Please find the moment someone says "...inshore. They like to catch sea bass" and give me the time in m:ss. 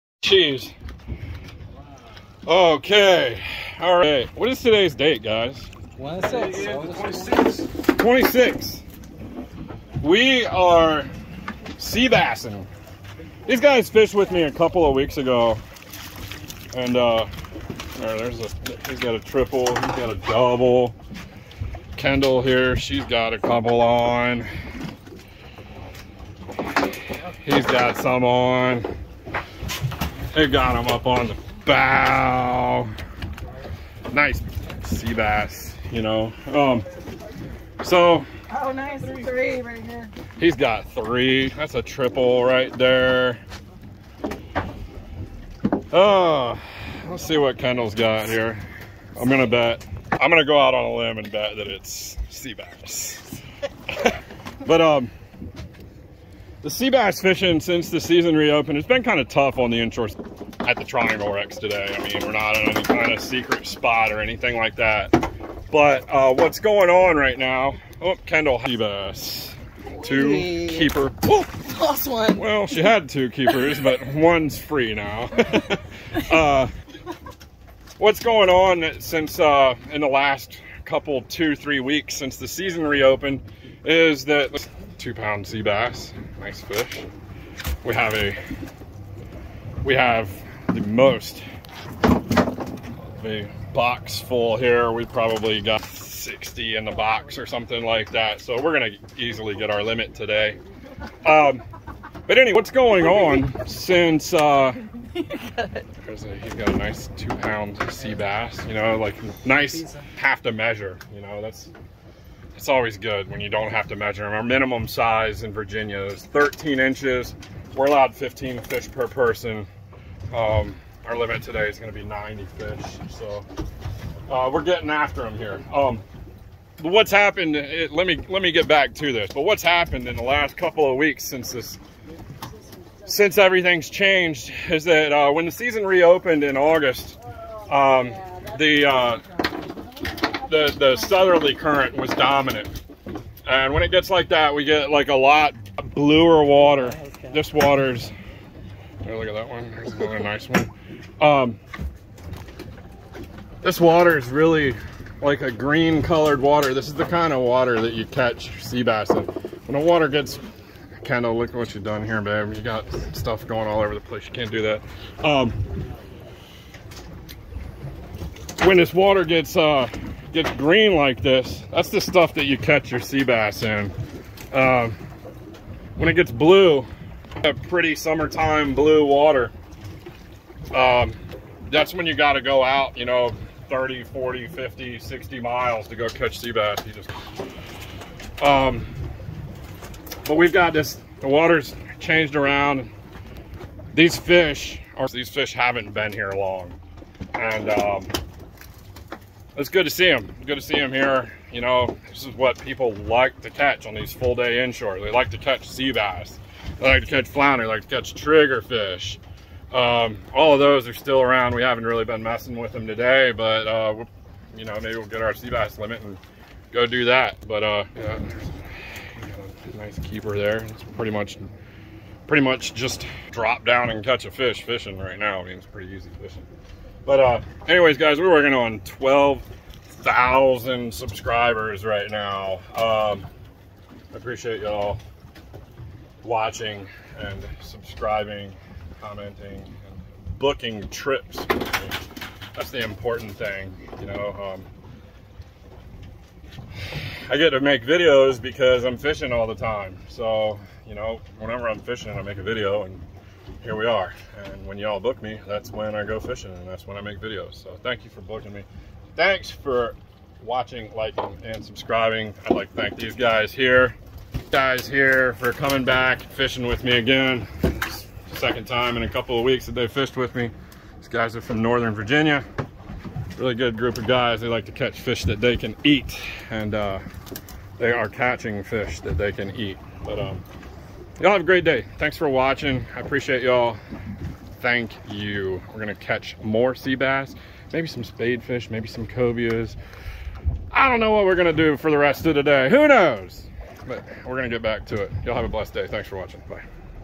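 3:24.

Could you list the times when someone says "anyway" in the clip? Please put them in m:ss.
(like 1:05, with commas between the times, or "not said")
1:42, 3:47.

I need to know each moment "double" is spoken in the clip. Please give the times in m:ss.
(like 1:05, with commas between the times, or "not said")
0:20.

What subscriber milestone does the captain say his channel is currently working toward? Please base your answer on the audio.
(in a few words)
12,000.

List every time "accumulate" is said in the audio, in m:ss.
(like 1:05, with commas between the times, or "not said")
not said.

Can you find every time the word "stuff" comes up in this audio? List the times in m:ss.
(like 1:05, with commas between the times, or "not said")
2:43, 2:52.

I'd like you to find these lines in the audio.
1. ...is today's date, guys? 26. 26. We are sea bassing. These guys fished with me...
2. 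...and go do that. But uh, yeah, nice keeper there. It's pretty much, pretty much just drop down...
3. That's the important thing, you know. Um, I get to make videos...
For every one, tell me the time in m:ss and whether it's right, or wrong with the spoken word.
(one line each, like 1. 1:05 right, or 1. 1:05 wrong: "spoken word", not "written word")
1. 0:04 right
2. 3:36 right
3. 4:02 right.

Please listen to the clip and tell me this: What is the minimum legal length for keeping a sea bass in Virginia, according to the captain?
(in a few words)
13 inches.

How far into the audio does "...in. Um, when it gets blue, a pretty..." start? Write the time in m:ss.
2:53.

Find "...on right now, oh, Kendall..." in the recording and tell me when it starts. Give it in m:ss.
1:06.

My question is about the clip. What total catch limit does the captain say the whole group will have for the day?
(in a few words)
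90 fish.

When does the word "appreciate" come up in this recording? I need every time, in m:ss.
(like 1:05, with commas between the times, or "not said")
3:54, 4:42.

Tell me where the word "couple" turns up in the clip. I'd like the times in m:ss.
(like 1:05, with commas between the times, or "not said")
0:14, 0:23, 1:20, 2:10, 4:29.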